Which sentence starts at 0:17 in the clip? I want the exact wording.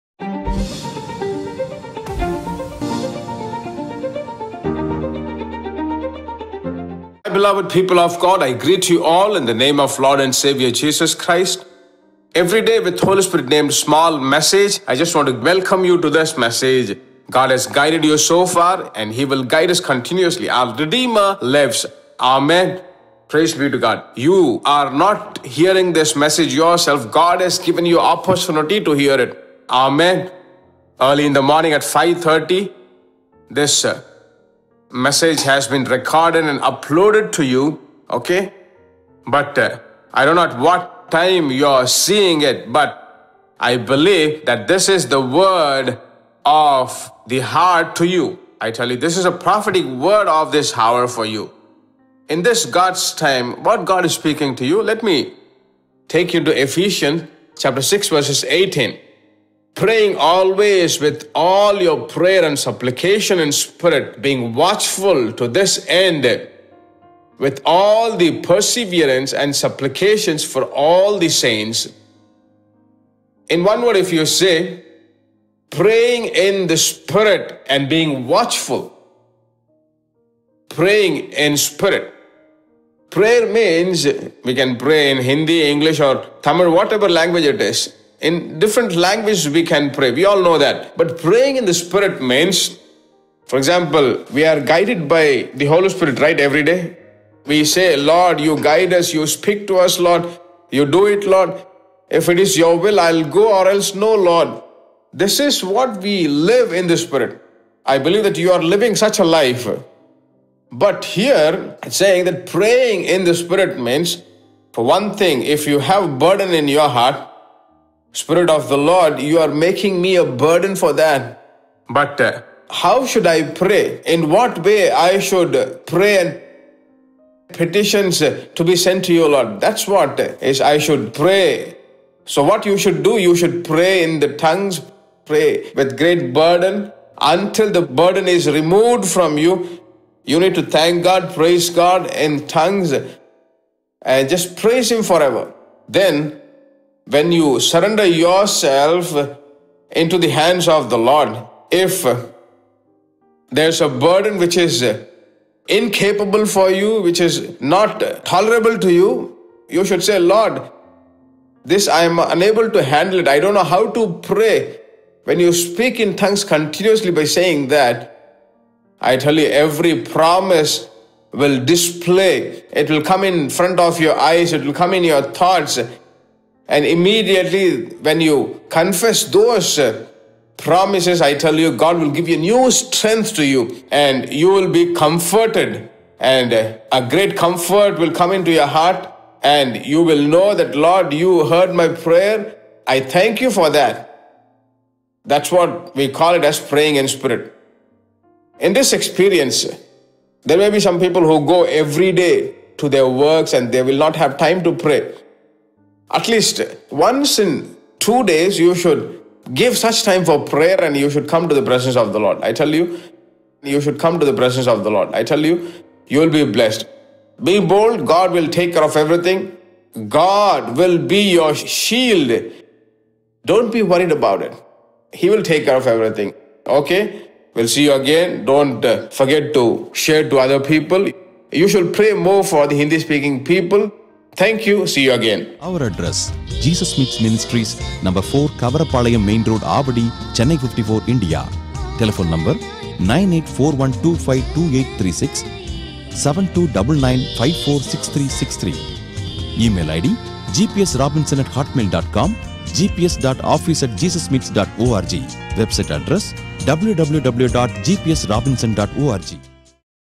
God has guided you so far and he will guide us continuously.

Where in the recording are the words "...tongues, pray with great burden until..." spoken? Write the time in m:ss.
2:14.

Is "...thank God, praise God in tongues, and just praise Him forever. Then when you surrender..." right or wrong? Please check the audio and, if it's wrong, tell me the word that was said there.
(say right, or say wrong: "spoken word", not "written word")
right.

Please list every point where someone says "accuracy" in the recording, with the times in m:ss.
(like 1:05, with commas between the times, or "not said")
not said.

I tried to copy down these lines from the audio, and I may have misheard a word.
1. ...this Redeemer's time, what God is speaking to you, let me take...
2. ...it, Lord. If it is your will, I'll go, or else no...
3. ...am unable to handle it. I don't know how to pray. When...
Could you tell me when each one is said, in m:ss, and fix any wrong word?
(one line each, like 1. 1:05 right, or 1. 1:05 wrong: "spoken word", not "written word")
1. 0:52 wrong: "God", not "Redeemer"
2. 1:41 right
3. 2:42 right.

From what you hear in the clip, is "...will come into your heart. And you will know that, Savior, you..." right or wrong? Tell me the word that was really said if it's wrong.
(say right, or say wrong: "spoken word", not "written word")
wrong: "Lord", not "Savior".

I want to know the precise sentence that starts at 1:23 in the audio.
Prayer means we can pray in Hindi, English, or Tamil, whatever language it is in different languages, we can pray.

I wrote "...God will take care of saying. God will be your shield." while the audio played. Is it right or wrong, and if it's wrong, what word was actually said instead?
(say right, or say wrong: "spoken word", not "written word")
wrong: "everything", not "saying".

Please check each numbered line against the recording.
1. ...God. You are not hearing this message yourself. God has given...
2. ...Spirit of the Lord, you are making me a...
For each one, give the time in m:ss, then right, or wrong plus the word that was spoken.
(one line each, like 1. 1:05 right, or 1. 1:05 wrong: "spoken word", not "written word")
1. 0:23 right
2. 1:58 right.